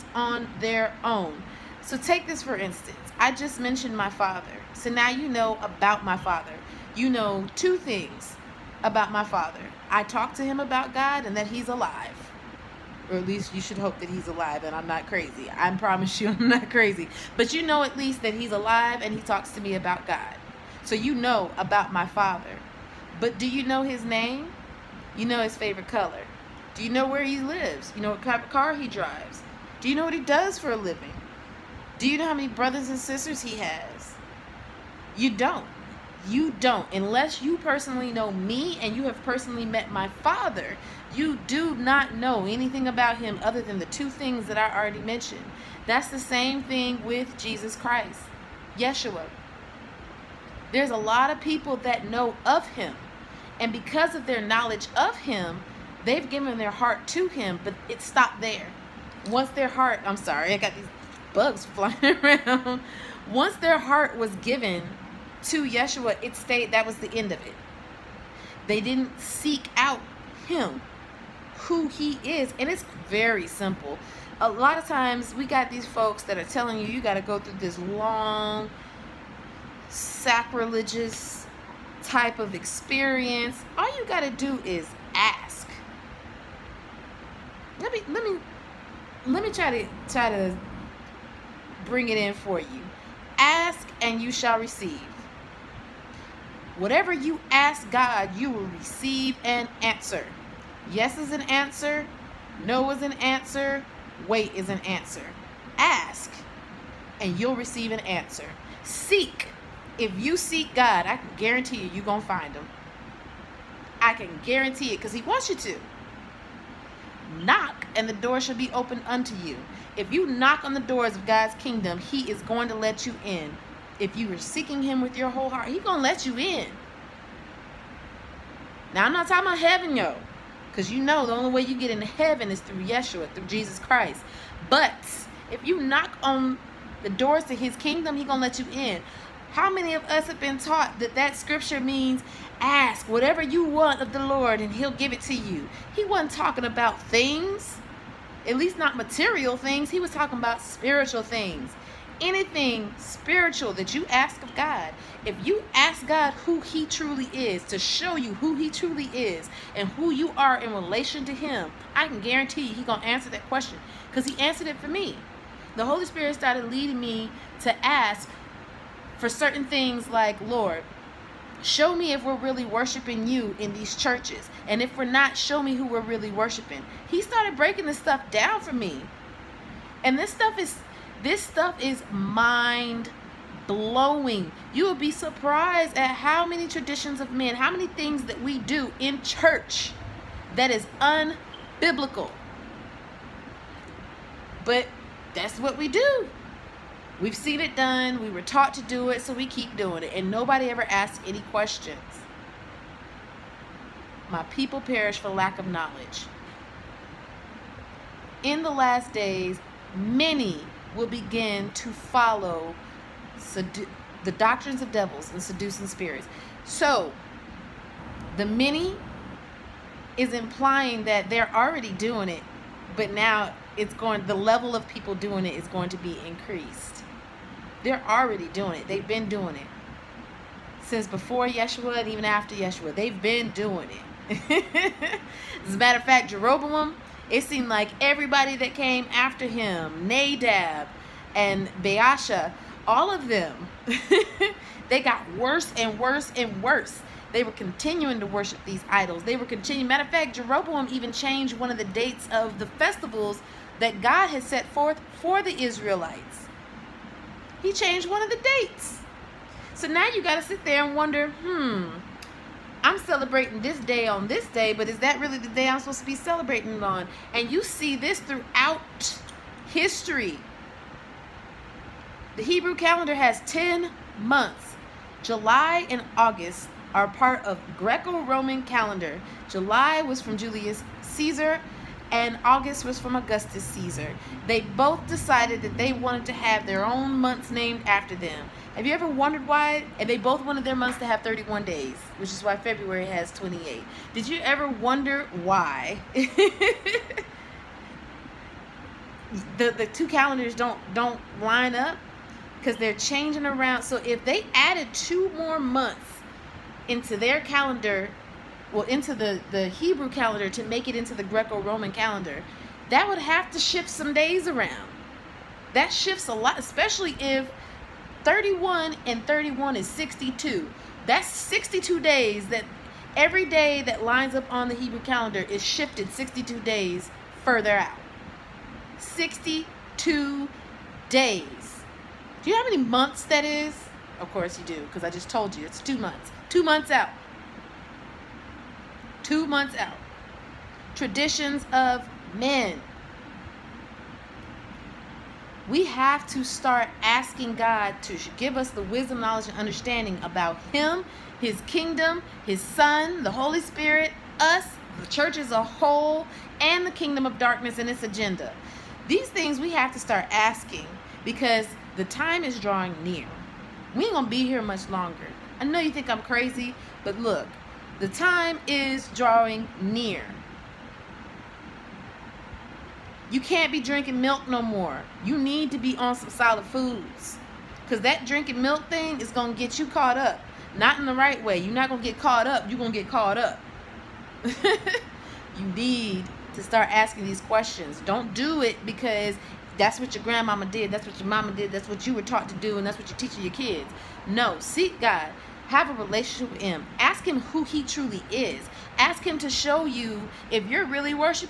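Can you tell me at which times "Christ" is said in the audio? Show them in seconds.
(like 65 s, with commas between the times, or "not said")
47 s, 133 s.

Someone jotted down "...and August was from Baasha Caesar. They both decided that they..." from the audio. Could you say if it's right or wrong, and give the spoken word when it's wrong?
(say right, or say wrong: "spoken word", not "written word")
wrong: "Augustus", not "Baasha".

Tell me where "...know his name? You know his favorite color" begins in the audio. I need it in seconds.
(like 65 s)
23 s.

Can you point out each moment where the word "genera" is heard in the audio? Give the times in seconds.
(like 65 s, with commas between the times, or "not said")
not said.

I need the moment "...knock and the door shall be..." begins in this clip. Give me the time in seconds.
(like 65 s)
117 s.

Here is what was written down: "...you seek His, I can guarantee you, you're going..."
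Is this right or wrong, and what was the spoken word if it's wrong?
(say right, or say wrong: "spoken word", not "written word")
wrong: "God", not "His".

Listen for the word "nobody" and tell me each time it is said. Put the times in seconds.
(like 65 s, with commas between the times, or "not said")
200 s.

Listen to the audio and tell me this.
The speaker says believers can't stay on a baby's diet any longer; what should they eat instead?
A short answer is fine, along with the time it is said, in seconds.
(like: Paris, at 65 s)
solid foods, at 376 s.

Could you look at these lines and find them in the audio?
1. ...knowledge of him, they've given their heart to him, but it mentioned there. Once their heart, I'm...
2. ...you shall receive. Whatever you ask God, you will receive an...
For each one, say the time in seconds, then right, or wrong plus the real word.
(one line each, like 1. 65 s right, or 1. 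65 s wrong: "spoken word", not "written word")
1. 54 s wrong: "stopped", not "mentioned"
2. 94 s right.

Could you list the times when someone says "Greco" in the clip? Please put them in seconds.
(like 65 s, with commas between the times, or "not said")
277 s, 311 s.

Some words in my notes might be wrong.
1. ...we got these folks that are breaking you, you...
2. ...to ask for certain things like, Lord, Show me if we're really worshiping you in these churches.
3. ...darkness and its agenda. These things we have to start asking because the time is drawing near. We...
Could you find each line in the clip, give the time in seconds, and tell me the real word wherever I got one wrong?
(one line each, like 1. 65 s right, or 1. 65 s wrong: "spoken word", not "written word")
1. 75 s wrong: "telling", not "breaking"
2. 167 s right
3. 357 s right.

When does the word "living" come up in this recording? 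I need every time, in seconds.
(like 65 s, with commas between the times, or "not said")
30 s.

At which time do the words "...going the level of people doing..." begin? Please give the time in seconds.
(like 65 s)
223 s.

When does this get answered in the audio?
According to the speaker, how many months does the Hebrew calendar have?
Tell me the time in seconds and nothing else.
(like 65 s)
273 s.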